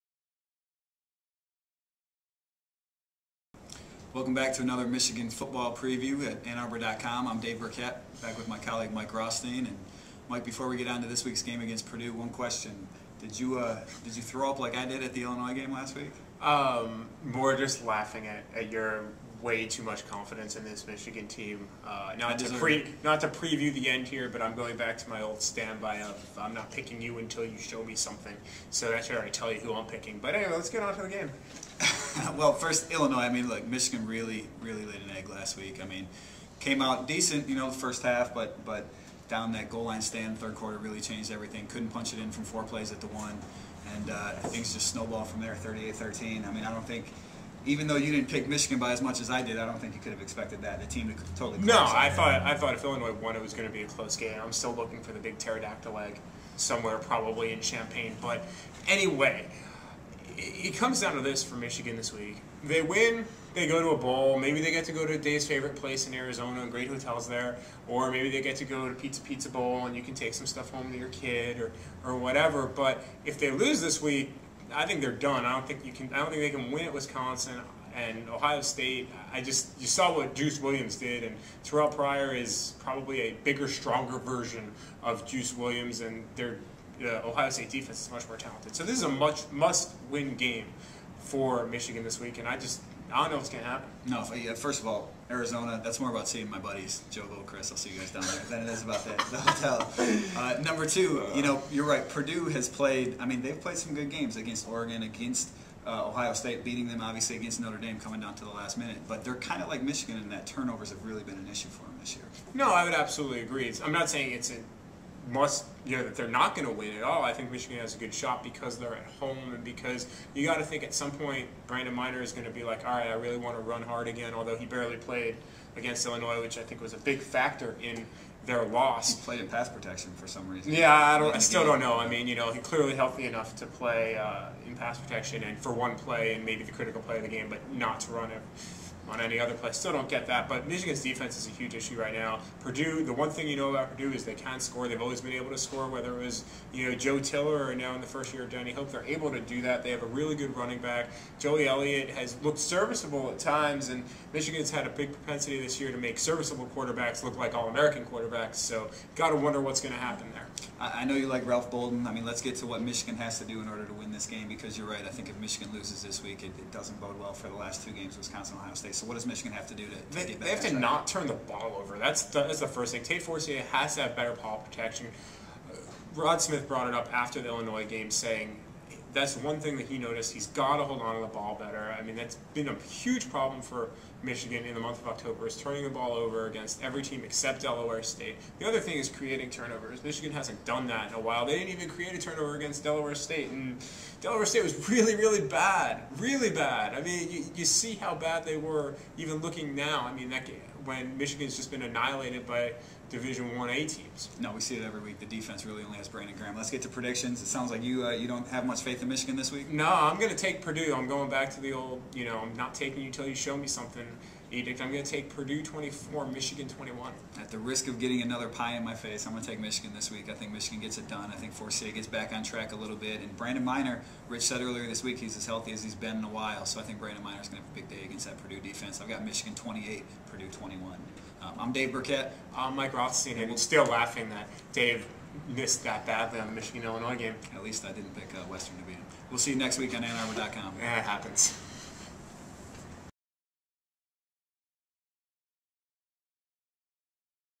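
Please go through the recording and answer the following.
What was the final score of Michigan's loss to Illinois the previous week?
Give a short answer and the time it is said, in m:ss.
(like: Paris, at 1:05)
38-13, at 0:45.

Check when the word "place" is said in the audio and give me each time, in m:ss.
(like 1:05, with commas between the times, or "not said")
1:05.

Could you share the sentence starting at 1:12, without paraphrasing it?
But if they lose this week, I think they're done.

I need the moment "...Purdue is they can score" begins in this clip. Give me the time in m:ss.
2:23.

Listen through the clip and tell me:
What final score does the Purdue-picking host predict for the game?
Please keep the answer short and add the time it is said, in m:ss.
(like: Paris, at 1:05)
Purdue 24, Michigan 21, at 3:35.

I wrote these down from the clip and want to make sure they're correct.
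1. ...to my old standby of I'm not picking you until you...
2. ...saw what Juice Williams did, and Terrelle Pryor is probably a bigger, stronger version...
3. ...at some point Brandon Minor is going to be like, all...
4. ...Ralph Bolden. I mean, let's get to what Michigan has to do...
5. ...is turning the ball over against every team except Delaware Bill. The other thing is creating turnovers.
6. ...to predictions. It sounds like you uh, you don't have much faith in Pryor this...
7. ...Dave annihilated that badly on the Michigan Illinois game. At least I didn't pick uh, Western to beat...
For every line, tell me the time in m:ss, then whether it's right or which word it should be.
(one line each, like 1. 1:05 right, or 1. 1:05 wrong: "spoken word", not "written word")
1. 0:24 right
2. 1:19 right
3. 2:00 right
4. 2:41 right
5. 3:05 wrong: "State", not "Bill"
6. 3:26 wrong: "Michigan", not "Pryor"
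7. 3:54 wrong: "missed", not "annihilated".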